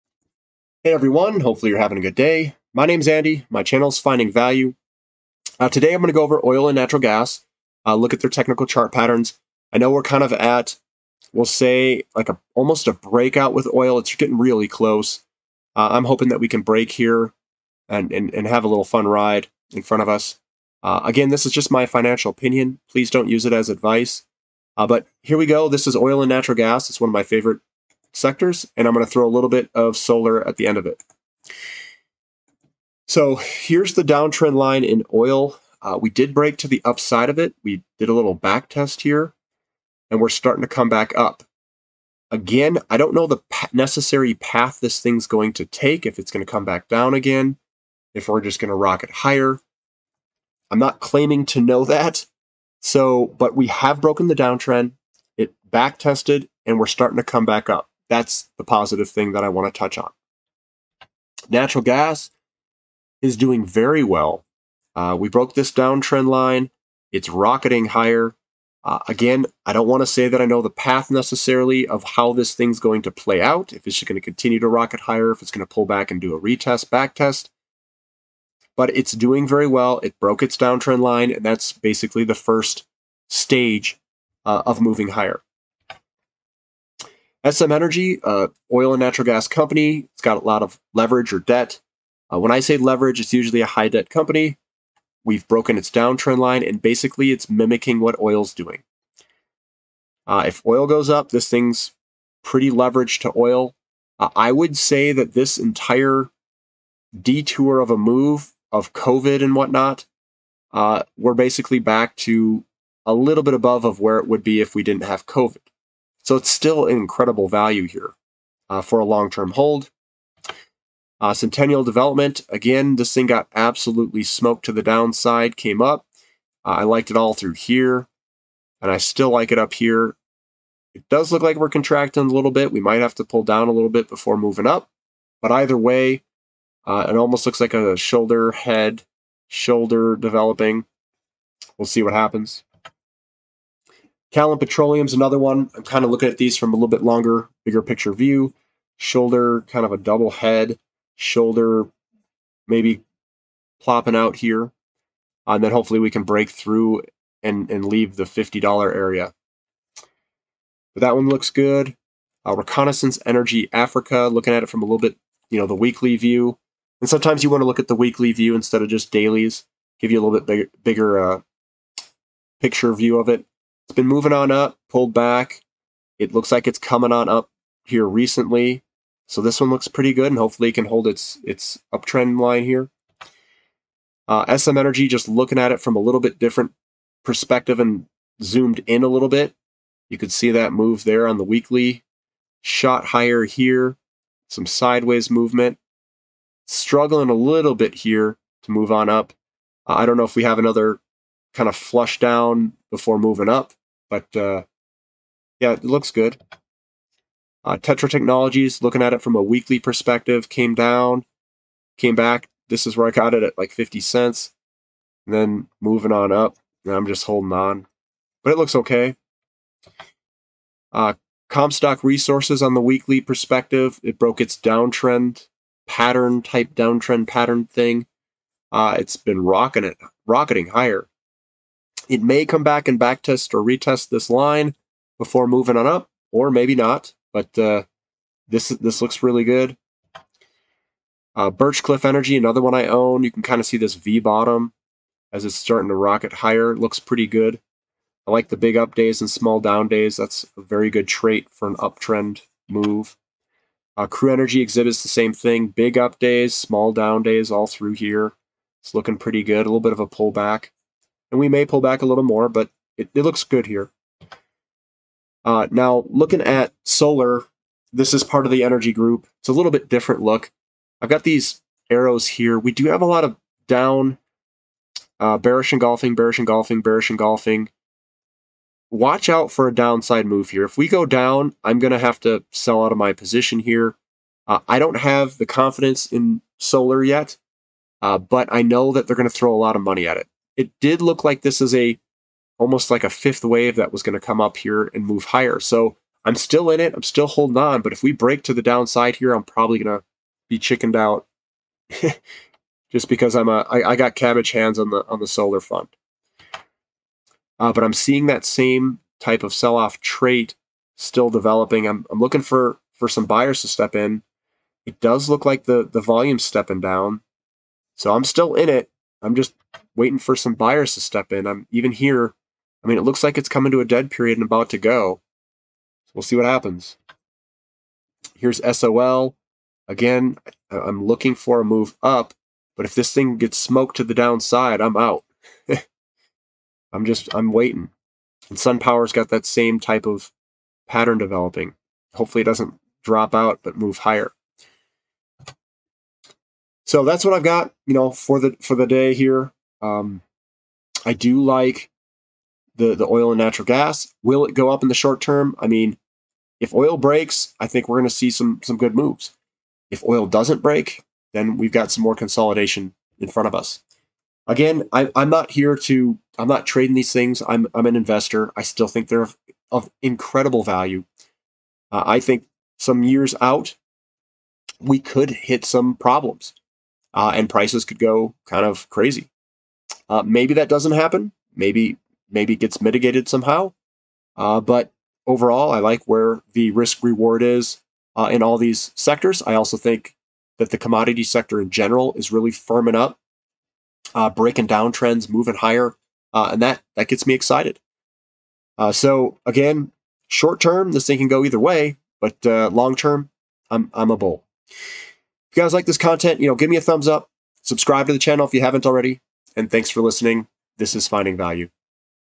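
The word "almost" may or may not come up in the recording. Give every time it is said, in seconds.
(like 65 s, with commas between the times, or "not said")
12 s, 137 s, 292 s.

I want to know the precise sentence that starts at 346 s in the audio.
So that's what I've got, you know, for the for the day here.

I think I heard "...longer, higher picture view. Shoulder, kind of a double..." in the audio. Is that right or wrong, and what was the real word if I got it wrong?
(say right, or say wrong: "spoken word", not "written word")
wrong: "bigger", not "higher".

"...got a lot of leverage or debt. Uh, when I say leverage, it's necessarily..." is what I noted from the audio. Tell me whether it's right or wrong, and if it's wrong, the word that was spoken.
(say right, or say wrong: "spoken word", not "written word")
wrong: "usually", not "necessarily".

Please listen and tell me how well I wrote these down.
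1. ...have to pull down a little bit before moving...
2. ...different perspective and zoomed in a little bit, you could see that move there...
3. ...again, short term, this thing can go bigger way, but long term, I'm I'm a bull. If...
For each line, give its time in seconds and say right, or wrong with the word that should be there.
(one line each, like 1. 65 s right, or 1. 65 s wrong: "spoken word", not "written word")
1. 133 s right
2. 186 s right
3. 399 s wrong: "either", not "bigger".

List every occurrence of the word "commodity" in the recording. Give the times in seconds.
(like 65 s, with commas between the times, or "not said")
390 s.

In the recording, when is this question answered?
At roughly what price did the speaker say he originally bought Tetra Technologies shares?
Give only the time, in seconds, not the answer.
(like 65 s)
213 s.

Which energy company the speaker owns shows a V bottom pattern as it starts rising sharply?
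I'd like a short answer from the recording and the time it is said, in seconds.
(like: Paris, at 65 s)
Birchcliff Energy, at 241 s.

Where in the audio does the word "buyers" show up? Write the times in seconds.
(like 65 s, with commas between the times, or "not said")
313 s, 320 s.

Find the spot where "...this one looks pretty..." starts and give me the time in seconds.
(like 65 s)
179 s.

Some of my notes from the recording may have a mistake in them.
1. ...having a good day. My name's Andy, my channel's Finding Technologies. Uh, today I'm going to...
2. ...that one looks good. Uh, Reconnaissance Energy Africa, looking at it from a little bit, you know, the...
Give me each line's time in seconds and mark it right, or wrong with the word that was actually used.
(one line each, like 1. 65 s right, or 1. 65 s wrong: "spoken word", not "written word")
1. 1 s wrong: "Value", not "Technologies"
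2. 161 s right.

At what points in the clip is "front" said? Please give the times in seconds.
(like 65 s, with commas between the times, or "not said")
19 s, 363 s.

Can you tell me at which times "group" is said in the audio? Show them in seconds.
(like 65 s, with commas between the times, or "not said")
268 s.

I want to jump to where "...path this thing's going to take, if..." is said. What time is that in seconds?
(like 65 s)
44 s.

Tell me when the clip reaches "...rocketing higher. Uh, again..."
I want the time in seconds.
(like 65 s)
67 s.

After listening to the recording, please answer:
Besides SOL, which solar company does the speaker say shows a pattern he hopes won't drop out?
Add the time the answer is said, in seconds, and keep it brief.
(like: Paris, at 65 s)
SunPower, at 338 s.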